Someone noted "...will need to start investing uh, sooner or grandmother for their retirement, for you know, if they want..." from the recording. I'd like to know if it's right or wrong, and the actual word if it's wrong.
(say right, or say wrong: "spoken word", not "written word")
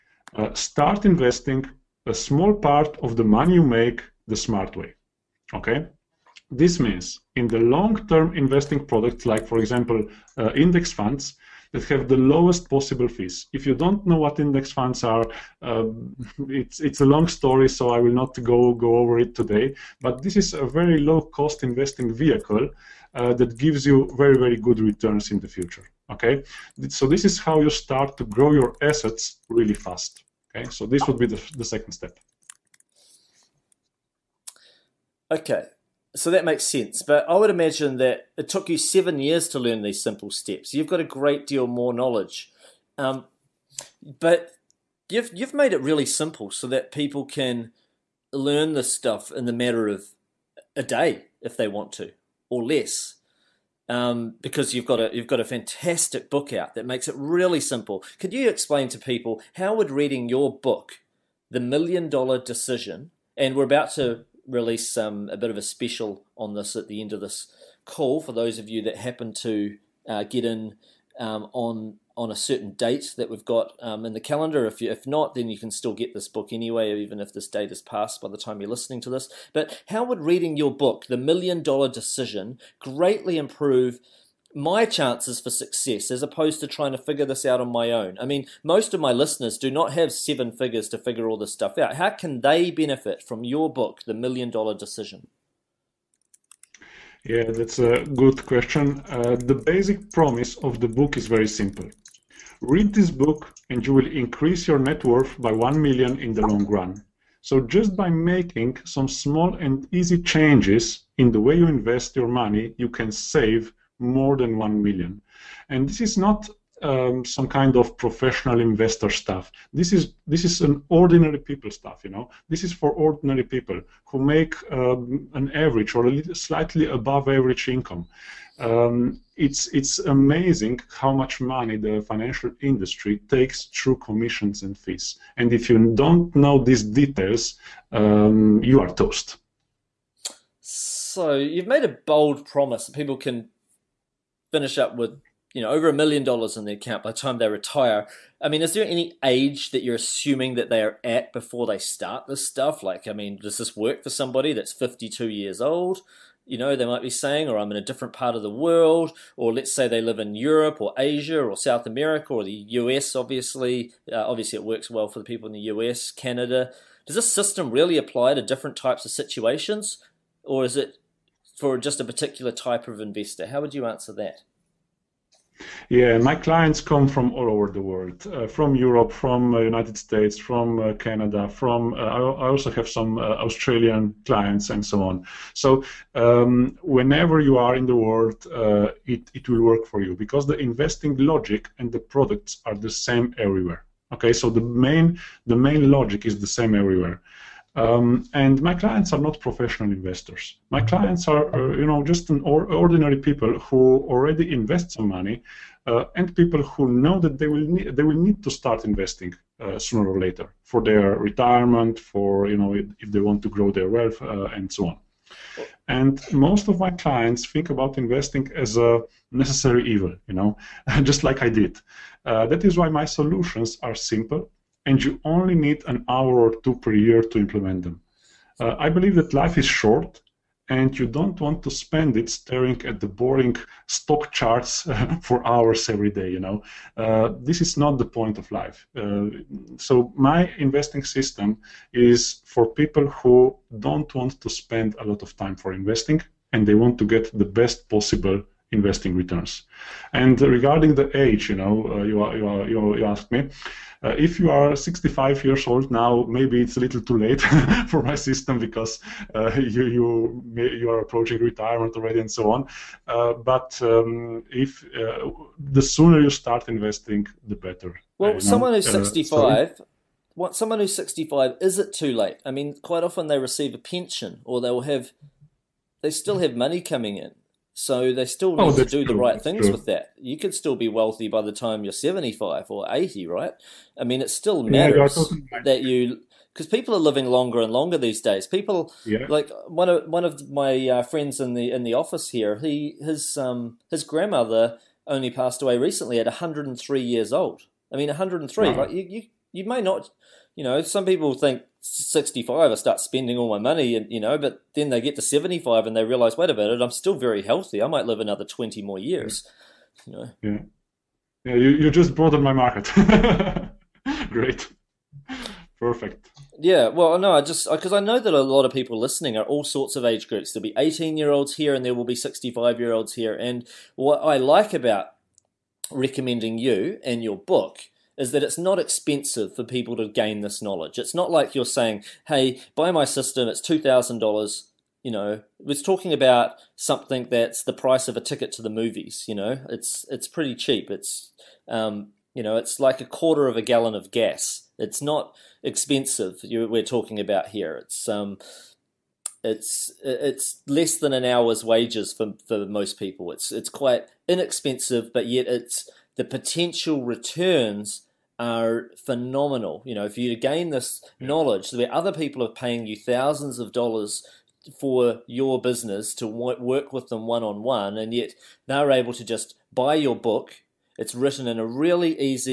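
wrong: "later", not "grandmother".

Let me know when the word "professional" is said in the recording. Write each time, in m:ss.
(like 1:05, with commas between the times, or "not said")
1:57, 3:19.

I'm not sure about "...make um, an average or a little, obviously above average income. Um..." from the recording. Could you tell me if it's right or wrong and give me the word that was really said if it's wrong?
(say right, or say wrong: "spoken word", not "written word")
wrong: "slightly", not "obviously".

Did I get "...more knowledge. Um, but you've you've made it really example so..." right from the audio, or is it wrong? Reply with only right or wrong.
wrong.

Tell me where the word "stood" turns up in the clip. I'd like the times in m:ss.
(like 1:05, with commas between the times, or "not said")
not said.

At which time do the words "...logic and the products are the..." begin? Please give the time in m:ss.
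3:11.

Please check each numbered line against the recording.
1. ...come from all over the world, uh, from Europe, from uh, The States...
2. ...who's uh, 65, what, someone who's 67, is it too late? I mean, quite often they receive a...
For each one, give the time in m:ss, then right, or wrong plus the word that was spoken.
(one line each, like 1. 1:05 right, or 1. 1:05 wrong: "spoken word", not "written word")
1. 2:56 wrong: "United", not "The"
2. 4:28 wrong: "65", not "67".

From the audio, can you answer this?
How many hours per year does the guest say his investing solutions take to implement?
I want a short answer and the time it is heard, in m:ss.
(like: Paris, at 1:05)
an hour or two, at 3:45.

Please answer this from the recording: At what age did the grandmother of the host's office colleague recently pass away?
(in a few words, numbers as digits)
103.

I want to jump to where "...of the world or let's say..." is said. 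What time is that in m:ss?
2:38.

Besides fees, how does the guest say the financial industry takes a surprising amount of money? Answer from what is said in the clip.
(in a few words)
commissions.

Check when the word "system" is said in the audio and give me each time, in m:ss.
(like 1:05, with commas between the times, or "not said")
2:47, 4:01, 4:18, 5:33.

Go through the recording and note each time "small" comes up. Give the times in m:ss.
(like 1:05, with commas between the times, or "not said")
0:02, 1:49.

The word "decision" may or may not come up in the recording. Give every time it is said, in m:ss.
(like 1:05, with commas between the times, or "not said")
1:02, 1:21, 1:34.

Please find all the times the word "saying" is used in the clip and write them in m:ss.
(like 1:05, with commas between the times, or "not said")
2:37, 5:31.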